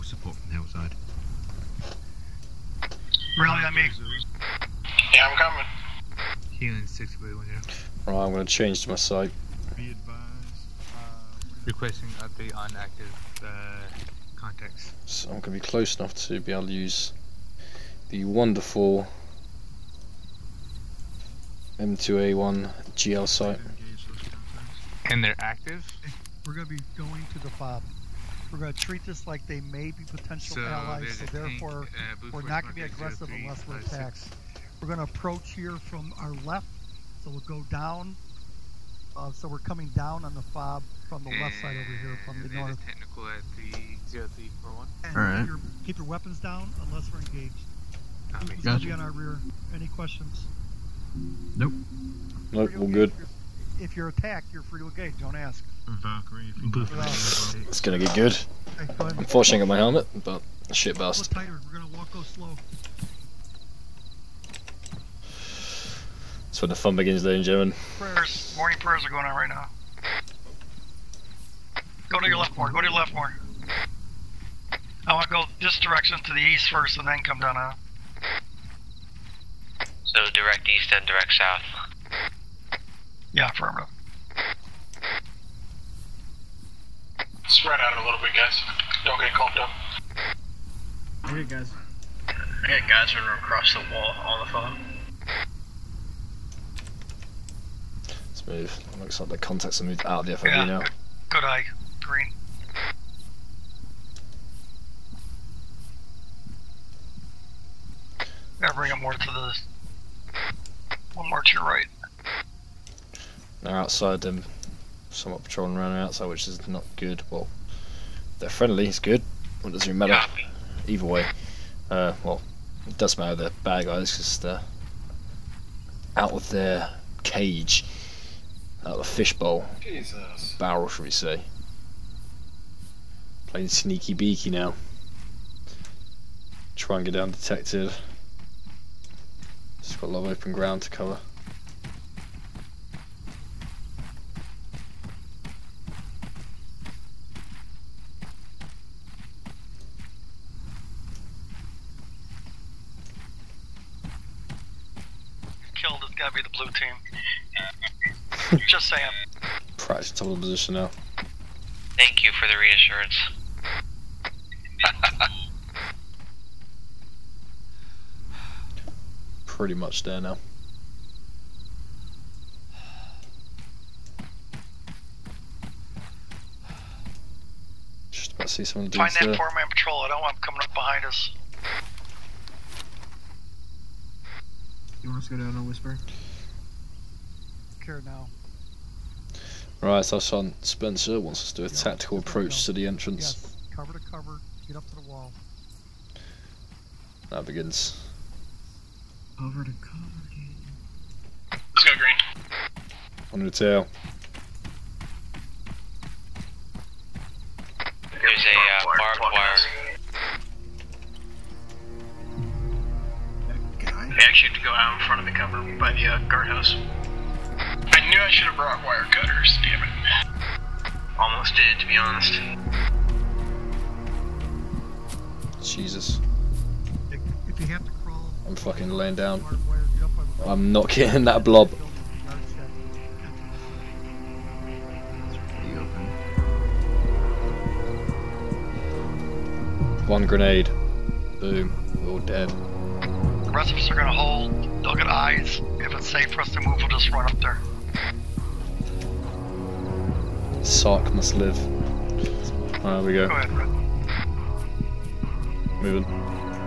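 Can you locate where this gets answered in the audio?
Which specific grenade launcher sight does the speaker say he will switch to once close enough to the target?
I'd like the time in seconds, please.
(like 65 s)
21 s.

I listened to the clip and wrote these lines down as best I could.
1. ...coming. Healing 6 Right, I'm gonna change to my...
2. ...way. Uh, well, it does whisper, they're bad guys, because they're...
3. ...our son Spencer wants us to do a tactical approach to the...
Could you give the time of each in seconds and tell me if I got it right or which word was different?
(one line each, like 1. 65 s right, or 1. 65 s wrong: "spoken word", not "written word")
1. 5 s right
2. 121 s wrong: "matter", not "whisper"
3. 190 s right.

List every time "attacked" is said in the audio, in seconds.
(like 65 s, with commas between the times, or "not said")
33 s, 54 s.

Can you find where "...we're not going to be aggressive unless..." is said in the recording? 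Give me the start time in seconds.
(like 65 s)
32 s.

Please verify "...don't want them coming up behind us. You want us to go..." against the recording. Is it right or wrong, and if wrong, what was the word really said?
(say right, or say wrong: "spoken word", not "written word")
right.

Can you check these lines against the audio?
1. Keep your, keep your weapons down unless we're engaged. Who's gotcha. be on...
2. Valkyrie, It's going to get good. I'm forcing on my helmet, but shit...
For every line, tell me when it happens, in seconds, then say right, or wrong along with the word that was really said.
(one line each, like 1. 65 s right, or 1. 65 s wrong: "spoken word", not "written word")
1. 45 s right
2. 56 s right.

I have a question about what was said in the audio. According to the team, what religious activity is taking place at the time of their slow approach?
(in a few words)
Morning prayers.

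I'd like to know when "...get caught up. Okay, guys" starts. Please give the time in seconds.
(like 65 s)
89 s.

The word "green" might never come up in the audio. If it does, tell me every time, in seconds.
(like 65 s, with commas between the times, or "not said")
102 s, 201 s.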